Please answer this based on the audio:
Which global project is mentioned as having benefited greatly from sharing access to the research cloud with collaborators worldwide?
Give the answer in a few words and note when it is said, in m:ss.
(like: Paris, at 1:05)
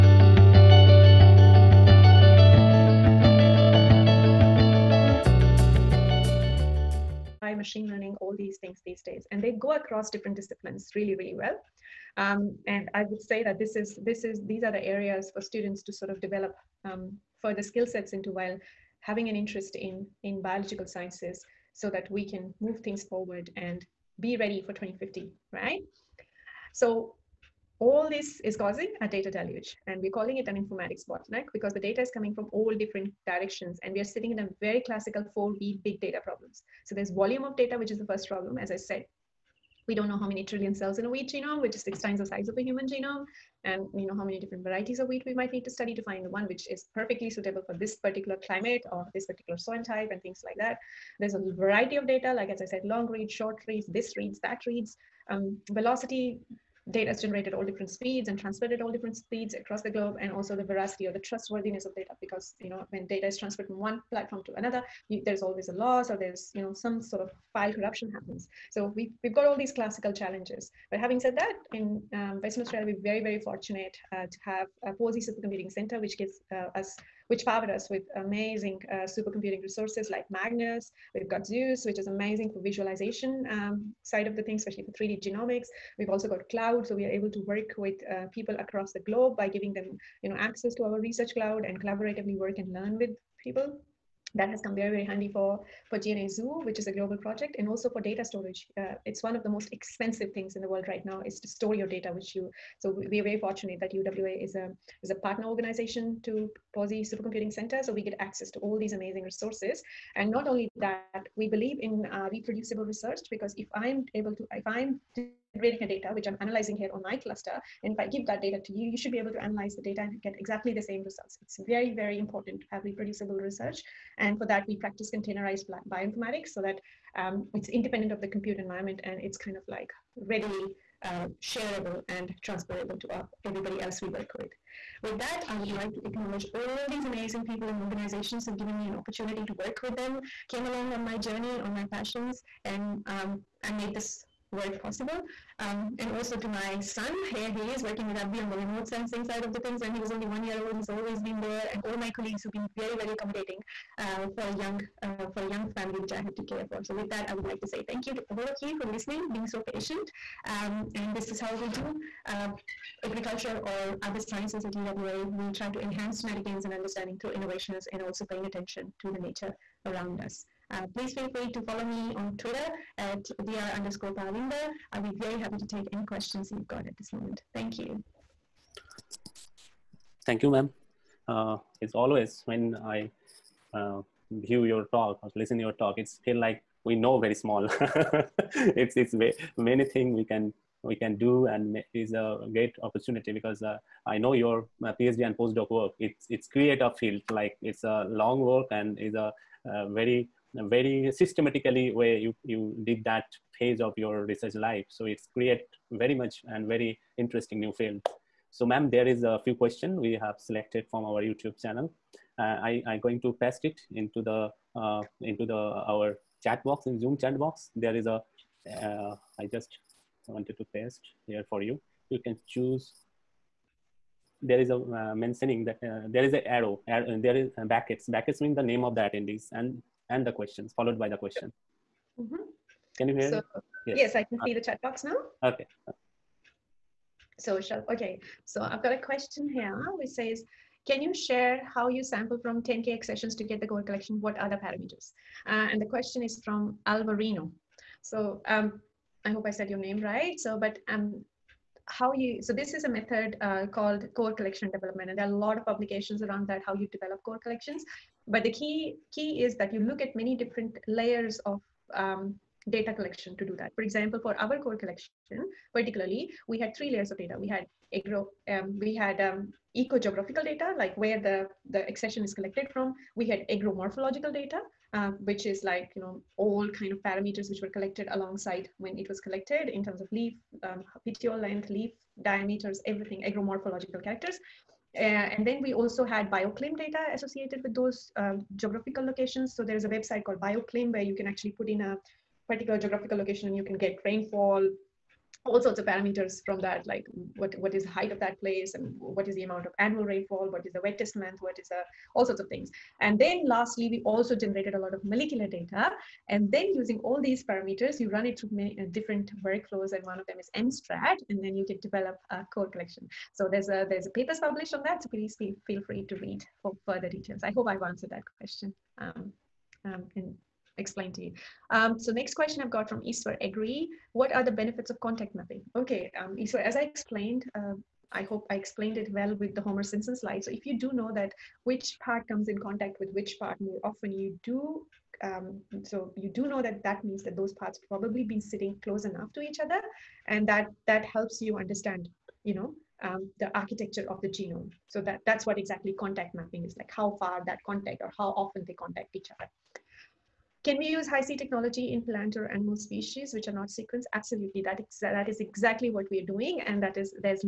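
DNA Zoo, at 1:35.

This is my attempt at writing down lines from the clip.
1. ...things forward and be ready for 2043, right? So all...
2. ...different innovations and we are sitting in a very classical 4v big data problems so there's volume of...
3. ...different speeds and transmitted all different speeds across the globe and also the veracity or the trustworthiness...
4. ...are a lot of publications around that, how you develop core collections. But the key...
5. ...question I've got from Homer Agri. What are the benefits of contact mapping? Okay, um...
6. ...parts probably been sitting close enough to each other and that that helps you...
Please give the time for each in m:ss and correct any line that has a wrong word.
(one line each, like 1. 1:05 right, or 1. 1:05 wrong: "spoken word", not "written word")
1. 0:22 wrong: "2050", not "2043"
2. 0:32 wrong: "directions", not "innovations"
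3. 0:57 right
4. 4:15 right
5. 5:22 wrong: "Iswar", not "Homer"
6. 5:37 right.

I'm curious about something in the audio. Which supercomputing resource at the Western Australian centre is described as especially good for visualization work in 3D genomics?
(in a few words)
Zeus.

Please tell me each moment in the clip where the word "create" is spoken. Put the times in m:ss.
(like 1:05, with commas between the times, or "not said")
3:16, 3:25.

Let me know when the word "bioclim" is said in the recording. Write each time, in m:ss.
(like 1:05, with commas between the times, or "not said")
4:46, 4:50.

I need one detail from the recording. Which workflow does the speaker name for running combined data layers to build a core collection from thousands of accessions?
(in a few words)
MSTRAT.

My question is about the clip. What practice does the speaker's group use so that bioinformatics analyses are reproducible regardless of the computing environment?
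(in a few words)
containerized bioinformatics.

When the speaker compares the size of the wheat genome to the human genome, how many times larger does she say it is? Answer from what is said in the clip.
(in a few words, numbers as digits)
6.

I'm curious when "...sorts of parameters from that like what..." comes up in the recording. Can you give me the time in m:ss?
4:55.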